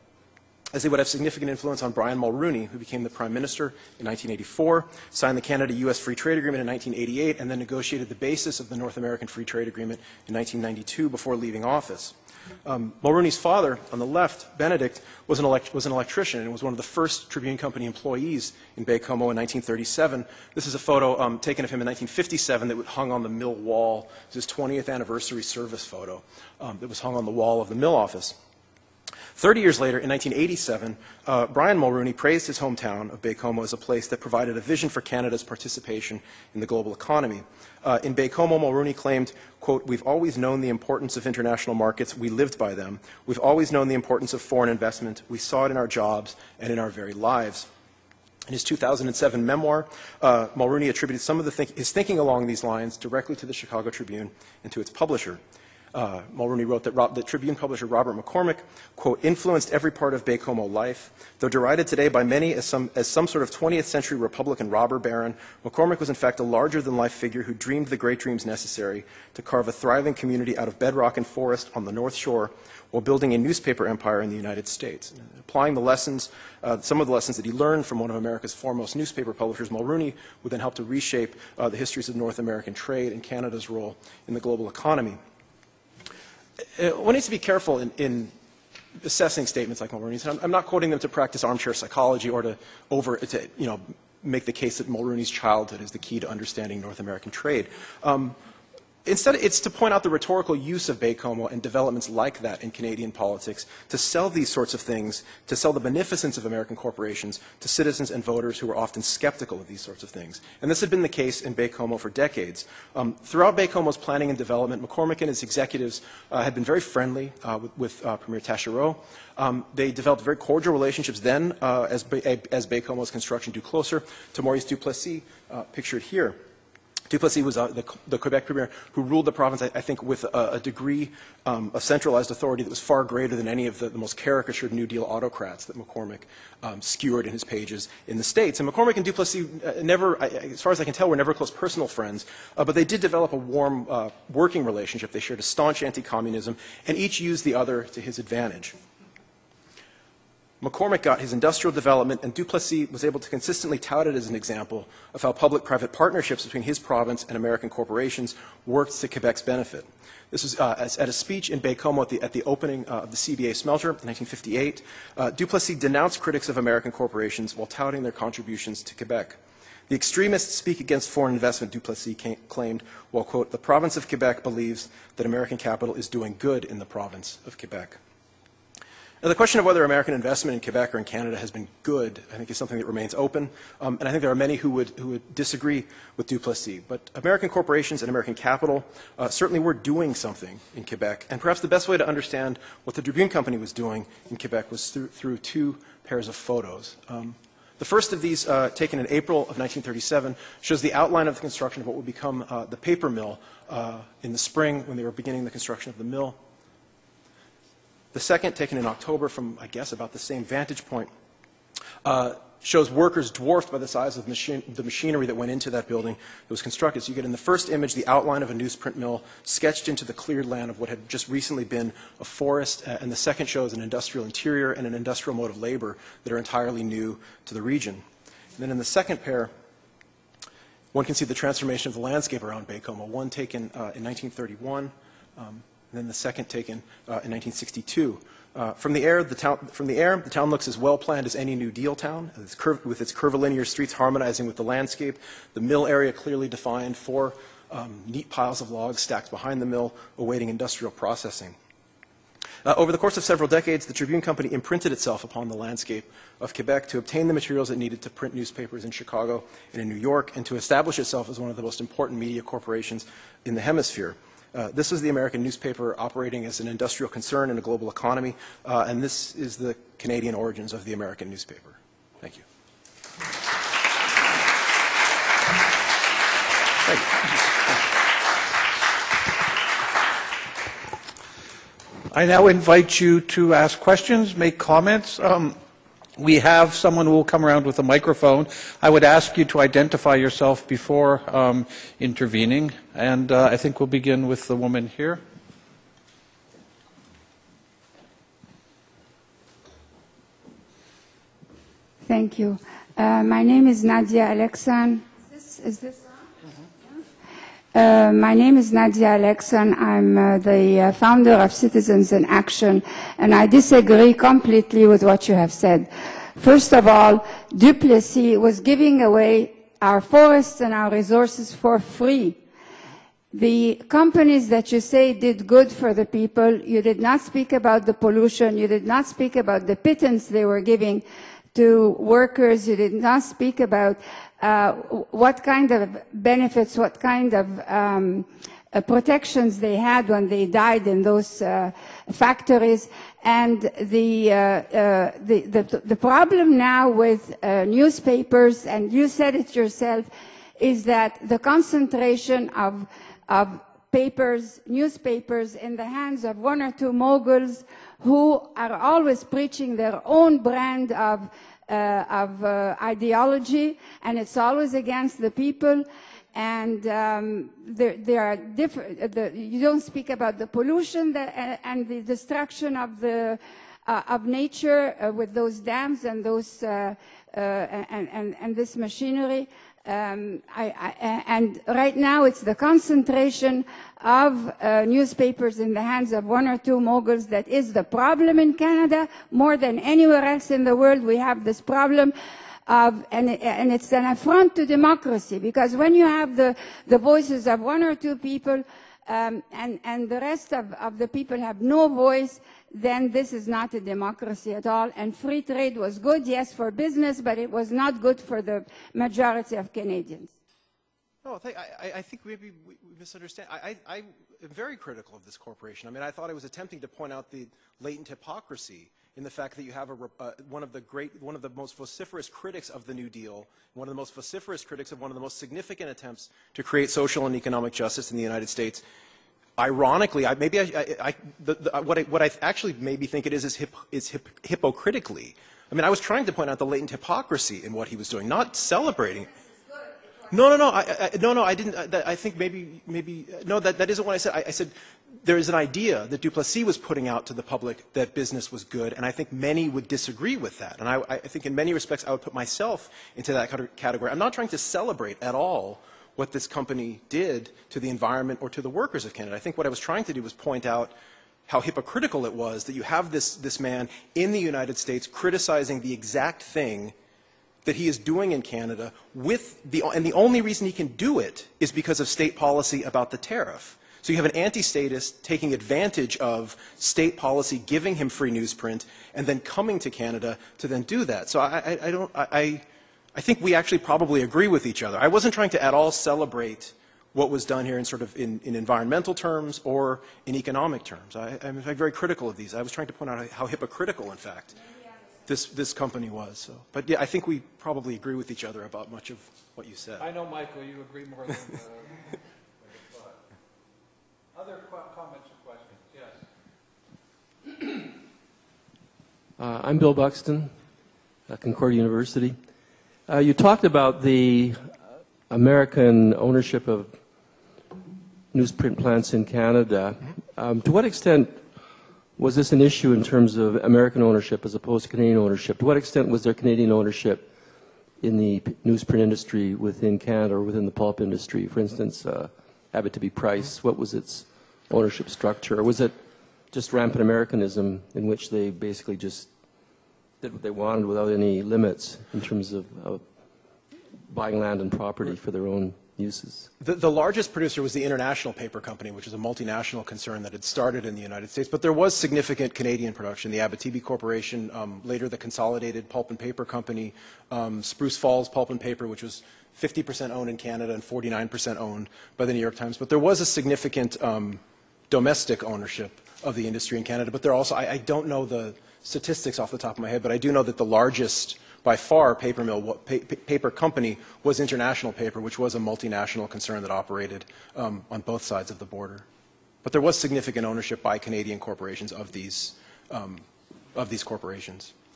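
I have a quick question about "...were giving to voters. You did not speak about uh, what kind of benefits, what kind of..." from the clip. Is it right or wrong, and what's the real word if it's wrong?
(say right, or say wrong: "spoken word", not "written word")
wrong: "workers", not "voters".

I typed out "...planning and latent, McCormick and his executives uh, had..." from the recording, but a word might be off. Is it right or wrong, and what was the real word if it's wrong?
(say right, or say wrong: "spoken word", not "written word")
wrong: "development", not "latent".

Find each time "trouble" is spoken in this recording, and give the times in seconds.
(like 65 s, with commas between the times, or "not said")
not said.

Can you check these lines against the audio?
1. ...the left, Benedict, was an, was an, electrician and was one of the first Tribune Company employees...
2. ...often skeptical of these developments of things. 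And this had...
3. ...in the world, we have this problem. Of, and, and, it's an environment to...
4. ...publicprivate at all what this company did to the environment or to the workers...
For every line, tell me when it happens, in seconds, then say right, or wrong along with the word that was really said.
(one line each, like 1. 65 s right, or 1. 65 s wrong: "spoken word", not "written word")
1. 13 s right
2. 108 s wrong: "sorts", not "developments"
3. 390 s wrong: "affront", not "environment"
4. 454 s wrong: "celebrate", not "publicprivate".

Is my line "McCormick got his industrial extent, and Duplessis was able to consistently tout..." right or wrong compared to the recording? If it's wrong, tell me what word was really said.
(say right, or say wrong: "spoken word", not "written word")
wrong: "development", not "extent".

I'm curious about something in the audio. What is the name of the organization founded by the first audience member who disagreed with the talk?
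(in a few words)
Citizens in Action.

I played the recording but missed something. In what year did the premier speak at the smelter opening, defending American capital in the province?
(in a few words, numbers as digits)
1958.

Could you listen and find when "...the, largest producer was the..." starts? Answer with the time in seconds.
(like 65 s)
546 s.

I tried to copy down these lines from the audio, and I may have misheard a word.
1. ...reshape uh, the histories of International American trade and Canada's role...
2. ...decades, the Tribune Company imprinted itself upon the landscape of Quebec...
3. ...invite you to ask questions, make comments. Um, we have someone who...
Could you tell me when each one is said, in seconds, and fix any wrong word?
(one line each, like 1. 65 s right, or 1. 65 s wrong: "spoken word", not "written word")
1. 80 s wrong: "North", not "International"
2. 253 s right
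3. 282 s right.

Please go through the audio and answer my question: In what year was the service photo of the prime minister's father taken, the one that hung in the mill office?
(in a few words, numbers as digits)
1957.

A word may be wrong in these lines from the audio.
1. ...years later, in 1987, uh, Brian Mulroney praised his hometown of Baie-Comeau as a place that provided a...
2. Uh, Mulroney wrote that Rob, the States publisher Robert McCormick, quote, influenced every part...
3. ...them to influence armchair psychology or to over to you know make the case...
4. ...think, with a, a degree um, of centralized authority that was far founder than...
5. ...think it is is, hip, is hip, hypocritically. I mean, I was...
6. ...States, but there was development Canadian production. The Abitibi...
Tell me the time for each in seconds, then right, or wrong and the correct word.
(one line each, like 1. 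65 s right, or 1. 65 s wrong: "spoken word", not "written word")
1. 29 s right
2. 55 s wrong: "Tribune", not "States"
3. 90 s wrong: "practice", not "influence"
4. 129 s wrong: "greater", not "founder"
5. 433 s right
6. 551 s wrong: "significant", not "development".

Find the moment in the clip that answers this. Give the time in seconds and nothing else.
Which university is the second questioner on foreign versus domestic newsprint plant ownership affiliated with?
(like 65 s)
511 s.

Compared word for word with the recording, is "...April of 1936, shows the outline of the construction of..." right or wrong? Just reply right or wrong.
wrong.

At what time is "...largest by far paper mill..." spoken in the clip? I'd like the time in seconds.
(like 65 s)
570 s.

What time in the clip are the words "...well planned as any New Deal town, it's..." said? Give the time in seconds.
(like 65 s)
240 s.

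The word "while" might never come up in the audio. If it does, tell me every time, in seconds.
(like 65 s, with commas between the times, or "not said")
72 s, 167 s, 173 s.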